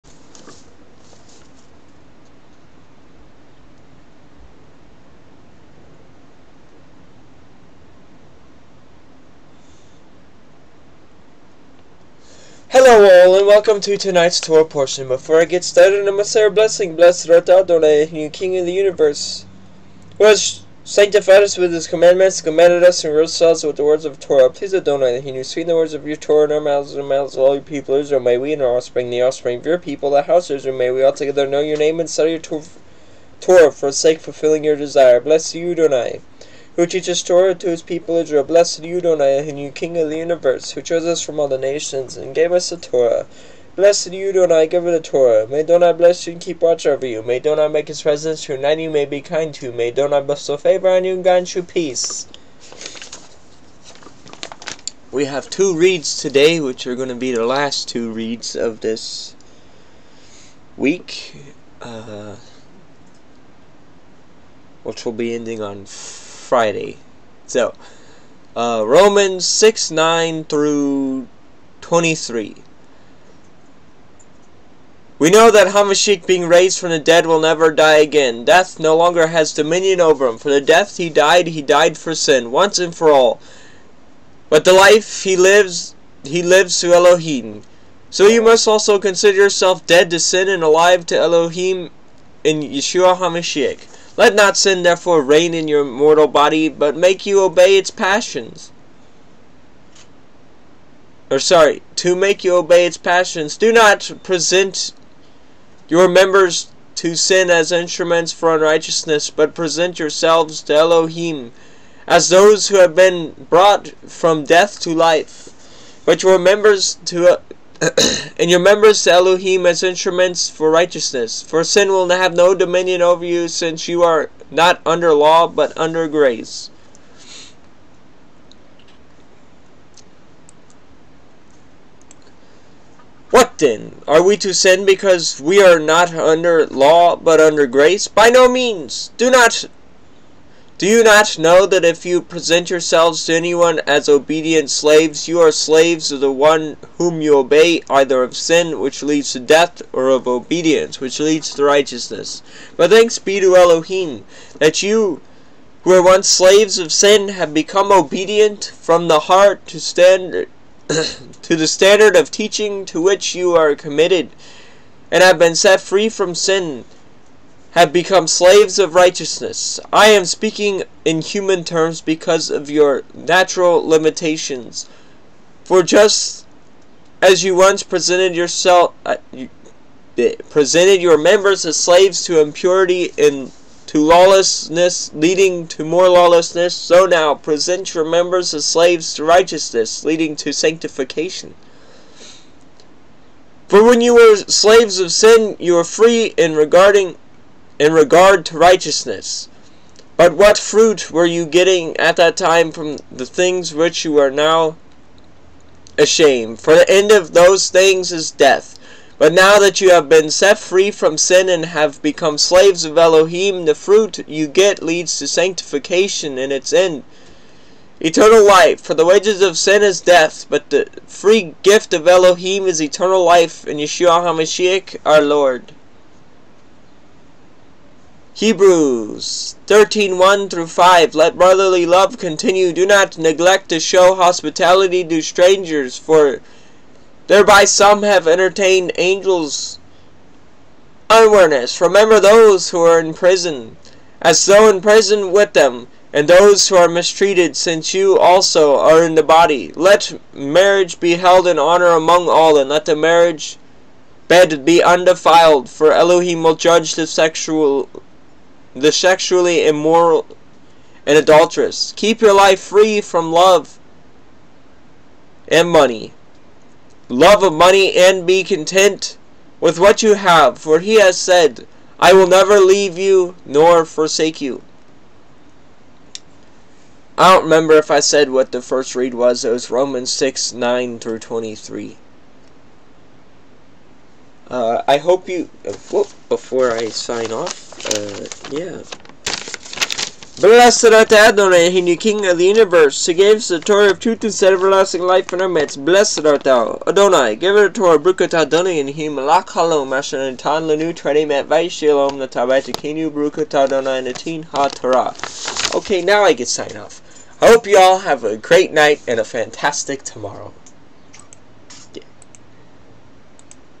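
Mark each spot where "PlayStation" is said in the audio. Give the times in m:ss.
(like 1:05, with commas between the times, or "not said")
not said.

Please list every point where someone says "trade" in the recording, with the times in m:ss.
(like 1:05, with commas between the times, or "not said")
not said.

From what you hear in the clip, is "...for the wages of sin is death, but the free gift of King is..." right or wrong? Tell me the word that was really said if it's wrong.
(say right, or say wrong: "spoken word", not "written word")
wrong: "Elohim", not "King".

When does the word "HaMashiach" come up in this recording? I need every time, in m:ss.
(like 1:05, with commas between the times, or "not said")
1:15, 1:33, 3:44.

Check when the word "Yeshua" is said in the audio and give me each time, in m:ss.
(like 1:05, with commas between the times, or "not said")
1:32, 3:43.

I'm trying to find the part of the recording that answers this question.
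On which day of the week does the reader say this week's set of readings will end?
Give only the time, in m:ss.
1:06.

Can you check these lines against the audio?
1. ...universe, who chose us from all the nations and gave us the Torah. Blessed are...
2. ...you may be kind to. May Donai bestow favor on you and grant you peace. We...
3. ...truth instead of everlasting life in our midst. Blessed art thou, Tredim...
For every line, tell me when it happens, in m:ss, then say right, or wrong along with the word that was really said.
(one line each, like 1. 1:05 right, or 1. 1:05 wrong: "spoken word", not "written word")
1. 0:40 right
2. 0:48 right
3. 4:53 wrong: "Adonai", not "Tredim".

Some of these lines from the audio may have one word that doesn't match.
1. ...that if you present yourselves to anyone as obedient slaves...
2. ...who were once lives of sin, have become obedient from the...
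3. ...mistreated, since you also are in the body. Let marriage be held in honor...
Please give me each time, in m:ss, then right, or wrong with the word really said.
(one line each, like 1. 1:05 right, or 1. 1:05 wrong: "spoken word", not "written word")
1. 2:21 right
2. 2:35 wrong: "slaves", not "lives"
3. 4:06 right.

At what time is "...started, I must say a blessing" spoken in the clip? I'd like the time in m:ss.
0:15.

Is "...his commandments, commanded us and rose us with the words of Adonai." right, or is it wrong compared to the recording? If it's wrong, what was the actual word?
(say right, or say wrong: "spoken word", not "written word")
wrong: "Torah", not "Adonai".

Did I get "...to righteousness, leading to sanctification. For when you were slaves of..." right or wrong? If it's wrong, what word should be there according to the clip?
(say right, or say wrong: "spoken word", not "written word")
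right.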